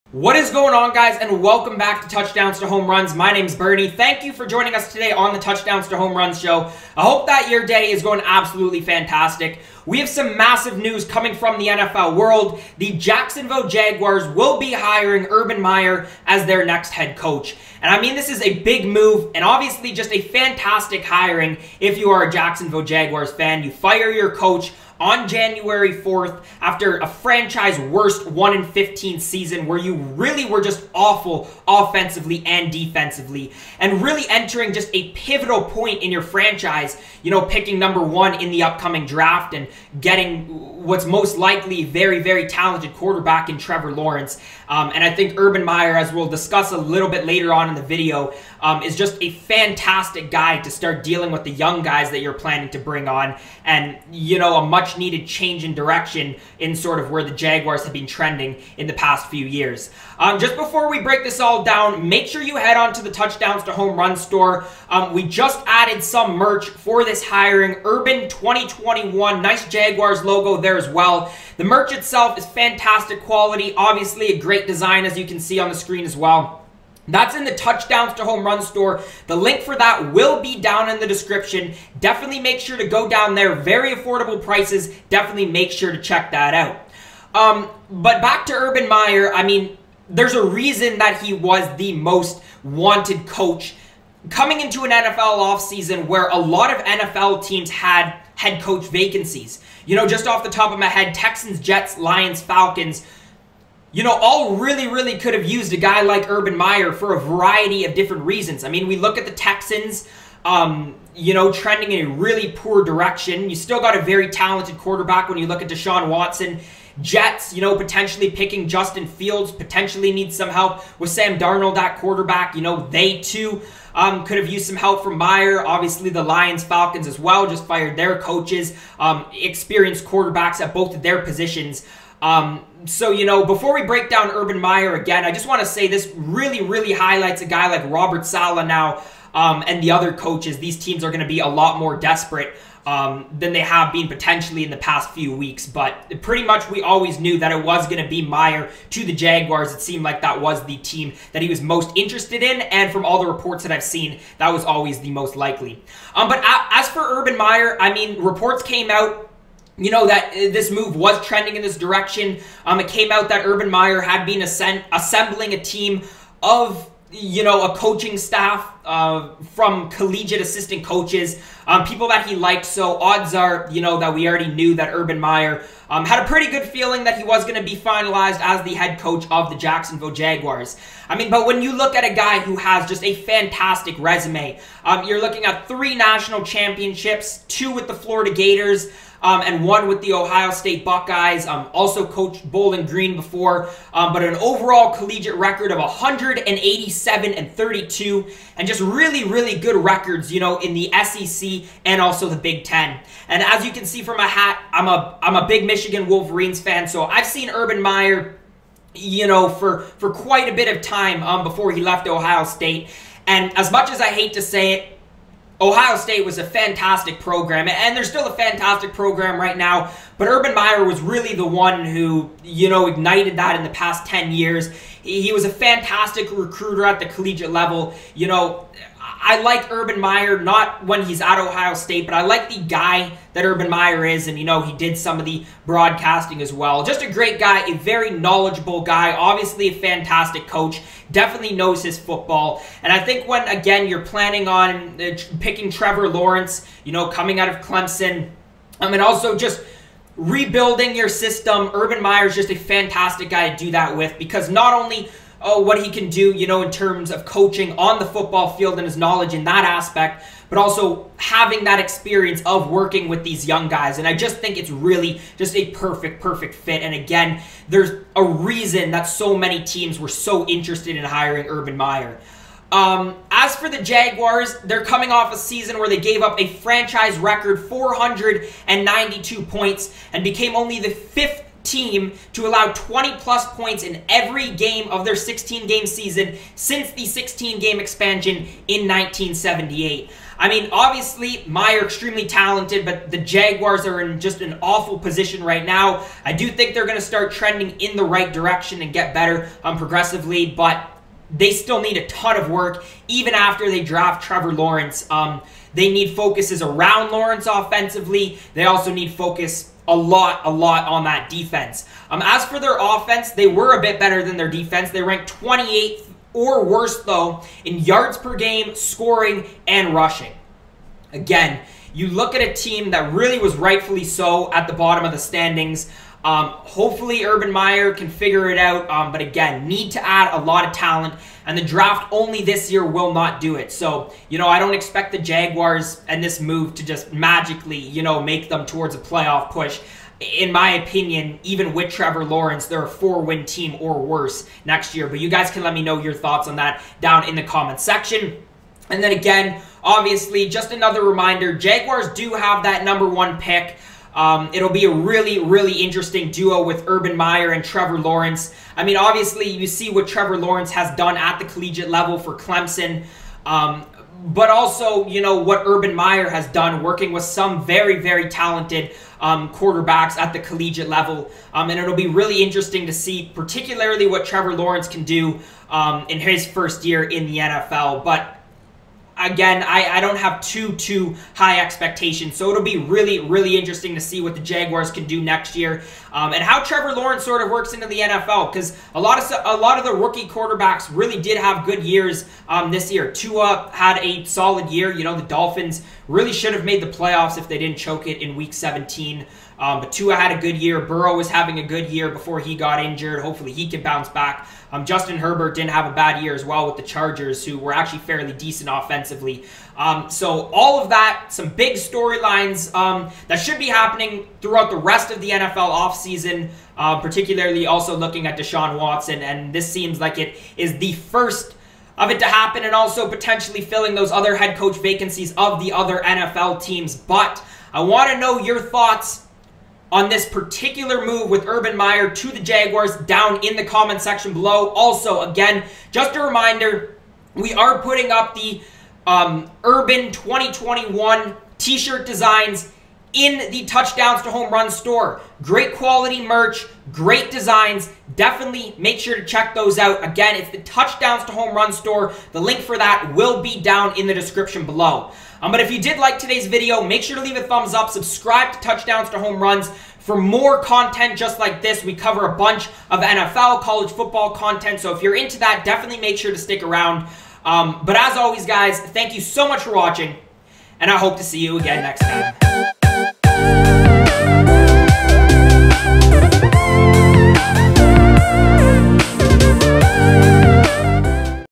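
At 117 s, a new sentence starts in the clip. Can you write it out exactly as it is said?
Jets, you know, potentially picking Justin Fields, potentially need some help with Sam Darnold at quarterback.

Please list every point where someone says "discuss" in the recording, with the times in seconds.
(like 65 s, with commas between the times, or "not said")
46 s.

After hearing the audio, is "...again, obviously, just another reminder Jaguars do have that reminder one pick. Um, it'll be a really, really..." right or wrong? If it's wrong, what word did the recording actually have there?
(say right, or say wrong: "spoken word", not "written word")
wrong: "number", not "reminder".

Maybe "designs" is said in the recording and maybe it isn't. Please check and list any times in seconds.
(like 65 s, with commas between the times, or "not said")
74 s, 442 s, 447 s.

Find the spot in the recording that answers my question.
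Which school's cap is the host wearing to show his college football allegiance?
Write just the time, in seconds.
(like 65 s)
205 s.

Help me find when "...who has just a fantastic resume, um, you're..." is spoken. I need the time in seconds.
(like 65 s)
182 s.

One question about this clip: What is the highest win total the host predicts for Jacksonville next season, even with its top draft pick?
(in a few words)
4.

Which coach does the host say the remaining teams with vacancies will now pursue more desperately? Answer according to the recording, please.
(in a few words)
Robert Saleh.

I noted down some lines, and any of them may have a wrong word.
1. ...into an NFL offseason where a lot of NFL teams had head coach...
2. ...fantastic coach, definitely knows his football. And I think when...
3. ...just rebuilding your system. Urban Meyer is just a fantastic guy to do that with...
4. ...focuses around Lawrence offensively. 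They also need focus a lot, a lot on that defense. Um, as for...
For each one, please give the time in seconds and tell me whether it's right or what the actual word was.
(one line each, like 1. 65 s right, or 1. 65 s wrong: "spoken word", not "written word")
1. 94 s right
2. 239 s right
3. 249 s right
4. 306 s right.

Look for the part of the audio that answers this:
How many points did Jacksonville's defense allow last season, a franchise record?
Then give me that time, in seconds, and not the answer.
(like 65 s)
277 s.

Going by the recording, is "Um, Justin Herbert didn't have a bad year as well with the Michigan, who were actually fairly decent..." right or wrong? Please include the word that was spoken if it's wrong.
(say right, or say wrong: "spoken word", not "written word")
wrong: "Chargers", not "Michigan".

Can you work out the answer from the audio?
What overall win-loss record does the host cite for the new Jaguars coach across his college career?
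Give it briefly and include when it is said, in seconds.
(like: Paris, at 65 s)
187-32, at 195 s.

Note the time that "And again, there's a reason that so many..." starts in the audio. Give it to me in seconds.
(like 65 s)
266 s.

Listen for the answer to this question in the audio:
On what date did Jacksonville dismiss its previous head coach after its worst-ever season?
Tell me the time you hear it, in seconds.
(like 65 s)
25 s.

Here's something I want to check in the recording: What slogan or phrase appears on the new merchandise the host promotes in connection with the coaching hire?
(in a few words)
Urban 2021.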